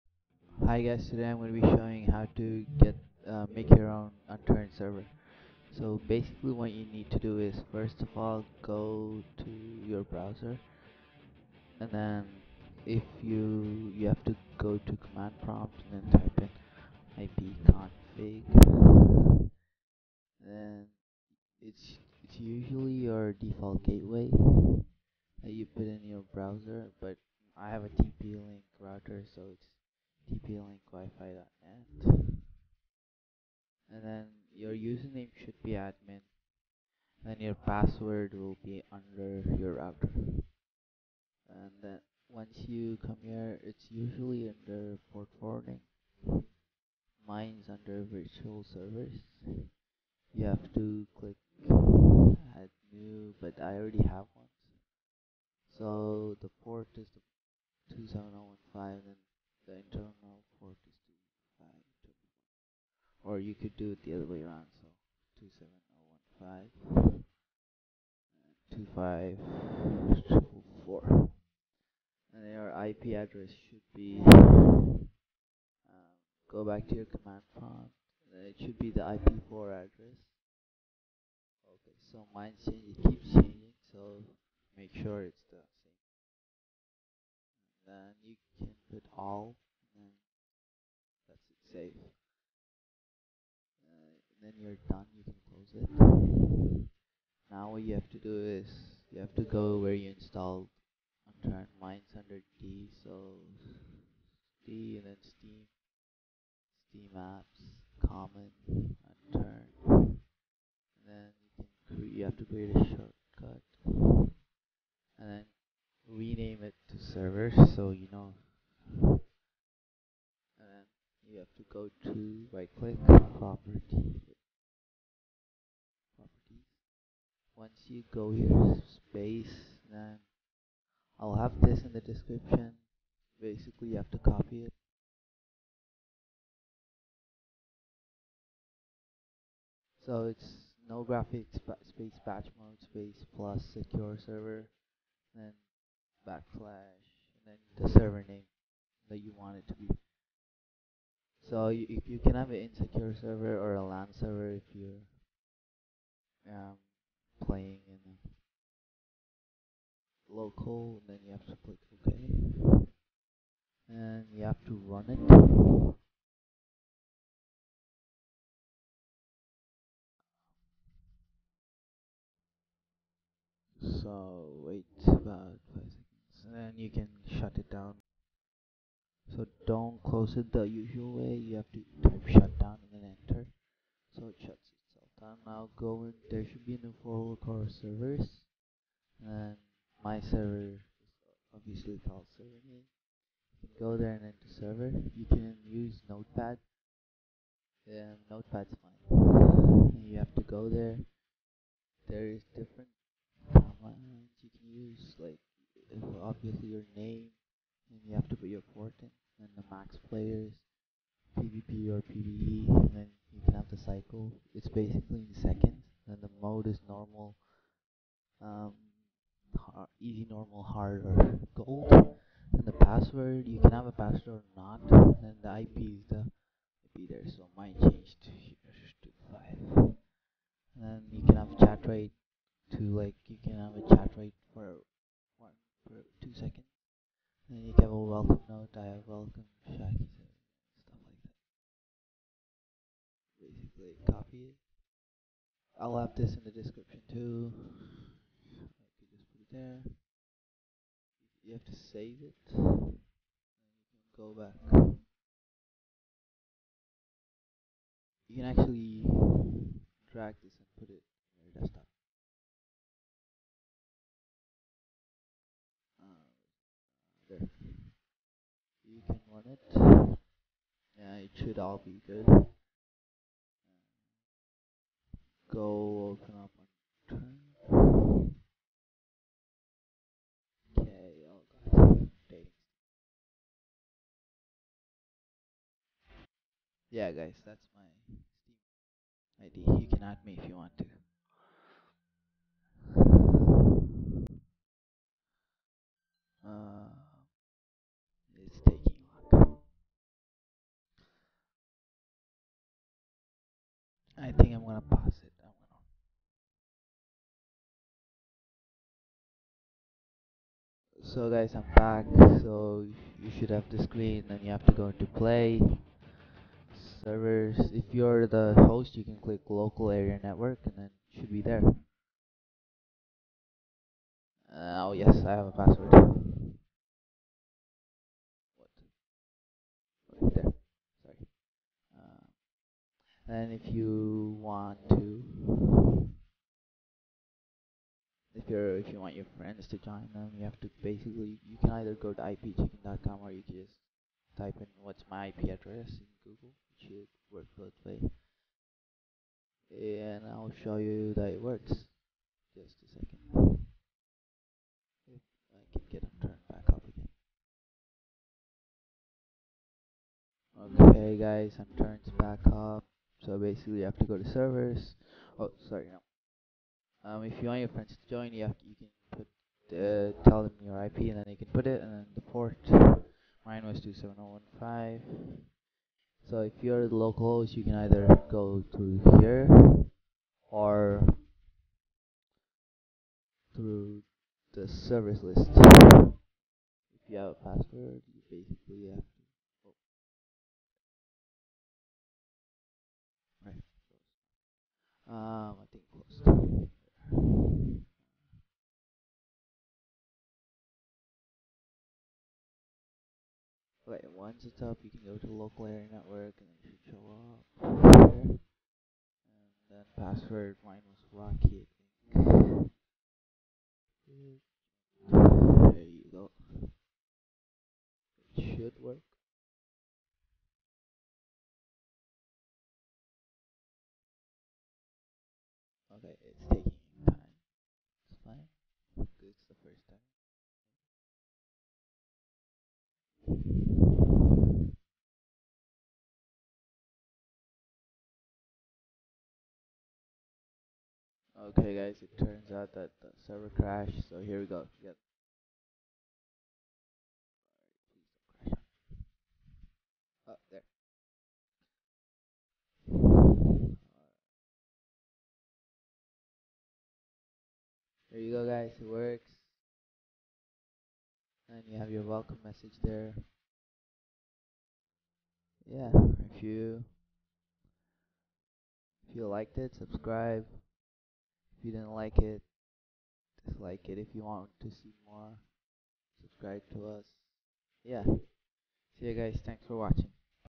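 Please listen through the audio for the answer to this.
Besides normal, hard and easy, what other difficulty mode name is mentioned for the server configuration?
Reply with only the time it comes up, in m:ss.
3:41.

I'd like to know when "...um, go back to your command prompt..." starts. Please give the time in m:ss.
1:14.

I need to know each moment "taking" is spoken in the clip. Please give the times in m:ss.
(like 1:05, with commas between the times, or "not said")
4:58, 7:06.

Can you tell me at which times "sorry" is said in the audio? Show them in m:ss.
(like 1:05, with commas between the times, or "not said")
5:31, 6:05.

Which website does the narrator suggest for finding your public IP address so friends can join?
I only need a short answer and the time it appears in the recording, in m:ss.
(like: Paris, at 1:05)
ipchicken.com, at 5:42.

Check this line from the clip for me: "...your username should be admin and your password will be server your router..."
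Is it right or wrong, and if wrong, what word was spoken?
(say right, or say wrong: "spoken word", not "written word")
wrong: "under", not "server".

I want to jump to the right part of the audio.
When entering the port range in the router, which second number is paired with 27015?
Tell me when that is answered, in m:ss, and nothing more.
1:10.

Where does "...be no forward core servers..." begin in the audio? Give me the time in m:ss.
3:06.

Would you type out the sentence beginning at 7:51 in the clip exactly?
If you didn't like it, dislike it.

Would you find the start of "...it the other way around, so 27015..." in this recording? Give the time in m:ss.
1:03.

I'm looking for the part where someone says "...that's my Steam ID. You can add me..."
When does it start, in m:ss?
4:47.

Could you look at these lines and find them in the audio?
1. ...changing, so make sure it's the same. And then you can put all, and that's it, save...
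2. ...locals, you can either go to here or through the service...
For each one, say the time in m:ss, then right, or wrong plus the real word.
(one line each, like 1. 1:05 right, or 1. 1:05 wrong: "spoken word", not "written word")
1. 1:23 right
2. 6:16 right.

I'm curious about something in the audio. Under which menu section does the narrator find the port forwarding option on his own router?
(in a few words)
virtual servers.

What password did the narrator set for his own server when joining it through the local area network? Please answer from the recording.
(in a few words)
Rocky.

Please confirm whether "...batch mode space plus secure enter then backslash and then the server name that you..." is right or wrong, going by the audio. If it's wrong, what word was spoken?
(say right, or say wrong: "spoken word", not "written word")
wrong: "server", not "enter".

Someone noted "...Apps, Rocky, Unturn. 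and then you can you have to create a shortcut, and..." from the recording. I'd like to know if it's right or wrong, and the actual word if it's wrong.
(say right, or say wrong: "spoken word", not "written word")
wrong: "Common", not "Rocky".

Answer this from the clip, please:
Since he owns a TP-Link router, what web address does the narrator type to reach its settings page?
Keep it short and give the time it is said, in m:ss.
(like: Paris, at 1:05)
tplinkwifi.net, at 0:30.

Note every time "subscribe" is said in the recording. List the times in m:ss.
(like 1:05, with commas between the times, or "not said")
7:49, 7:56.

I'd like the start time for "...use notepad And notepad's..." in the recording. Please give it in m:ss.
3:15.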